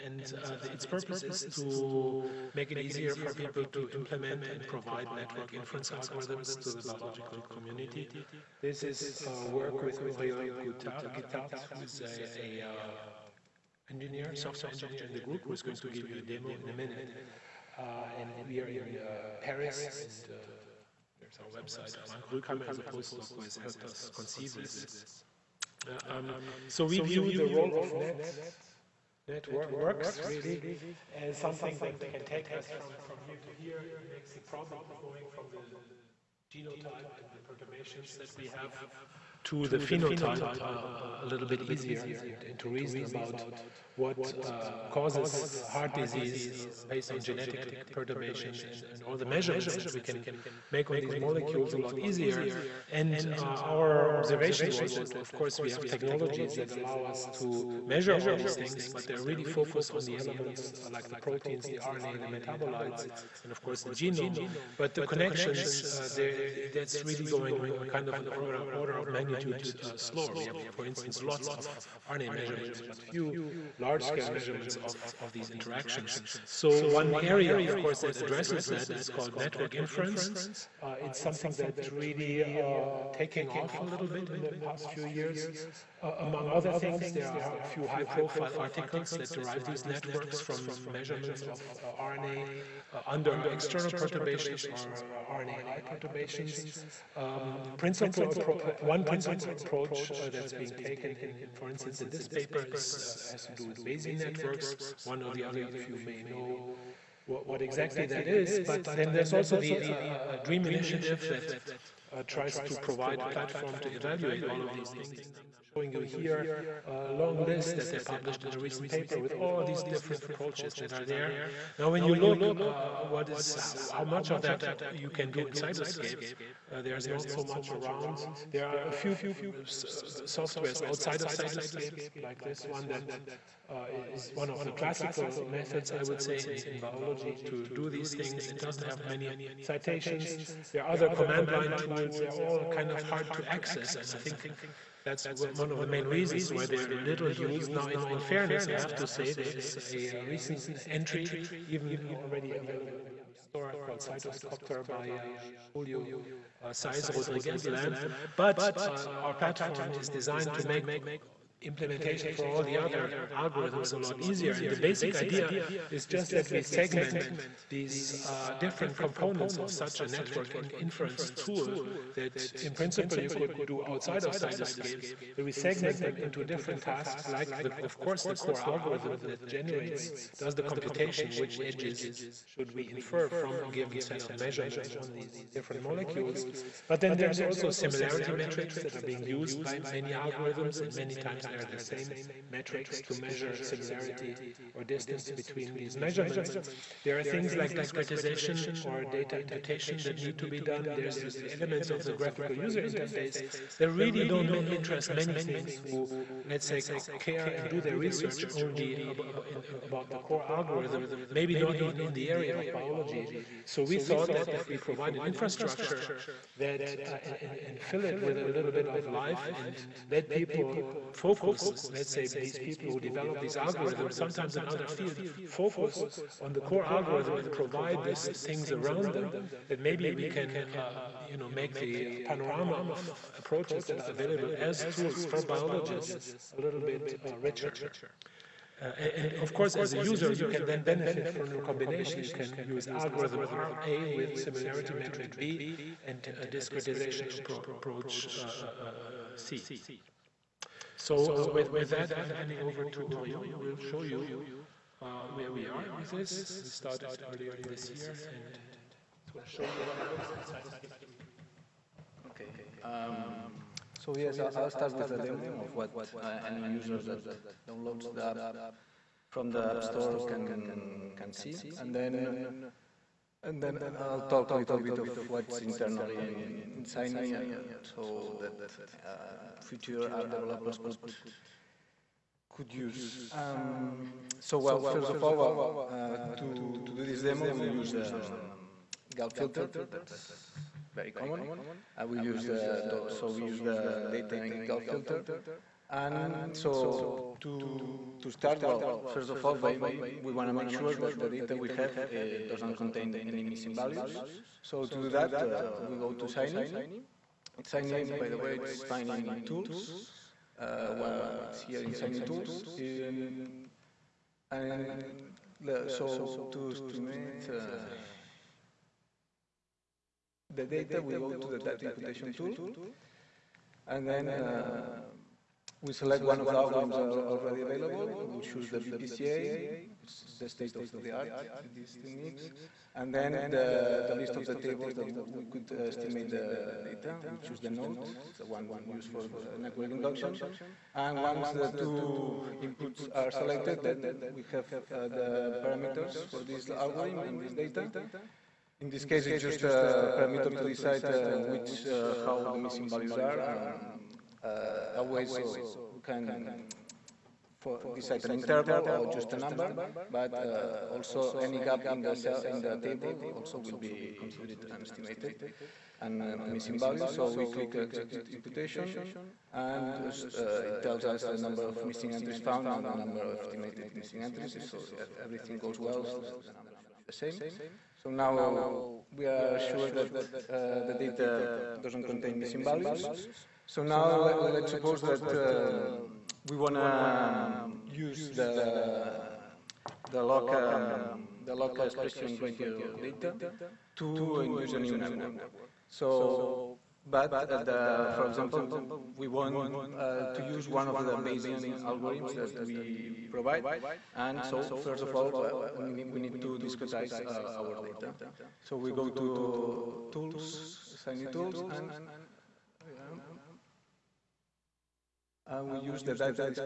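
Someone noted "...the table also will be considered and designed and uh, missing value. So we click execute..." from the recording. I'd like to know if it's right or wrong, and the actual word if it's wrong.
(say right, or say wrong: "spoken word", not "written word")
wrong: "estimated", not "designed".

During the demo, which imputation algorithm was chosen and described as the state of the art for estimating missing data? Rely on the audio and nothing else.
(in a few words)
BPCA.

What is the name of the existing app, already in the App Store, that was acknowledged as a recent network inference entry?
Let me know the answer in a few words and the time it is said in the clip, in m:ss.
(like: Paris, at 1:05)
CytoCopter, at 2:33.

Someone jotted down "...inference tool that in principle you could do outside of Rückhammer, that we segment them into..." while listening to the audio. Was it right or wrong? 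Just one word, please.
wrong.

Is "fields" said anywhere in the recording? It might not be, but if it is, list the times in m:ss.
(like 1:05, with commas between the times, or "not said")
3:44.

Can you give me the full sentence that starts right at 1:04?
But the connections, uh, that's really going uh, kind of an order, order of magnitude uh, slower.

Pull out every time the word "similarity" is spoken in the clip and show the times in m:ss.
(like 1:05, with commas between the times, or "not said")
3:07, 3:13, 4:04.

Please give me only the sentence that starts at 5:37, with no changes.
We choose the node, it's the one we'll use for uh, network induction.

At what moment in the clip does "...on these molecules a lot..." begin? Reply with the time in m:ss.
0:50.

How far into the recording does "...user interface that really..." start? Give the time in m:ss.
3:22.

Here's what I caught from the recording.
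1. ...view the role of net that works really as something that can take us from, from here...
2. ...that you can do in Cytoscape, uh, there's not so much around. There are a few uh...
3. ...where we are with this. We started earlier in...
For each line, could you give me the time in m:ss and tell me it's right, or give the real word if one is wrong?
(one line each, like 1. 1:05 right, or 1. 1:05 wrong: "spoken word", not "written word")
1. 0:27 right
2. 2:04 right
3. 4:15 right.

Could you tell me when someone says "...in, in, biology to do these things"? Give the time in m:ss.
2:16.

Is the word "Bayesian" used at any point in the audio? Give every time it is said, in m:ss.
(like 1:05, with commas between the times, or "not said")
1:43, 6:41.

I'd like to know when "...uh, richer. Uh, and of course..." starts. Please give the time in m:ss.
3:57.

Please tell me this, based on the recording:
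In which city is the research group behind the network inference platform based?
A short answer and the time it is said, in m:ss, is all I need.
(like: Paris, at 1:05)
Paris, at 0:19.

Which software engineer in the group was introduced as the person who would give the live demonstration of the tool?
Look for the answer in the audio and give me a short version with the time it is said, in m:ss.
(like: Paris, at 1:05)
Oriol Guitart, at 0:10.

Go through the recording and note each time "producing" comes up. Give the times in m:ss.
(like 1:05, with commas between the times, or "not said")
not said.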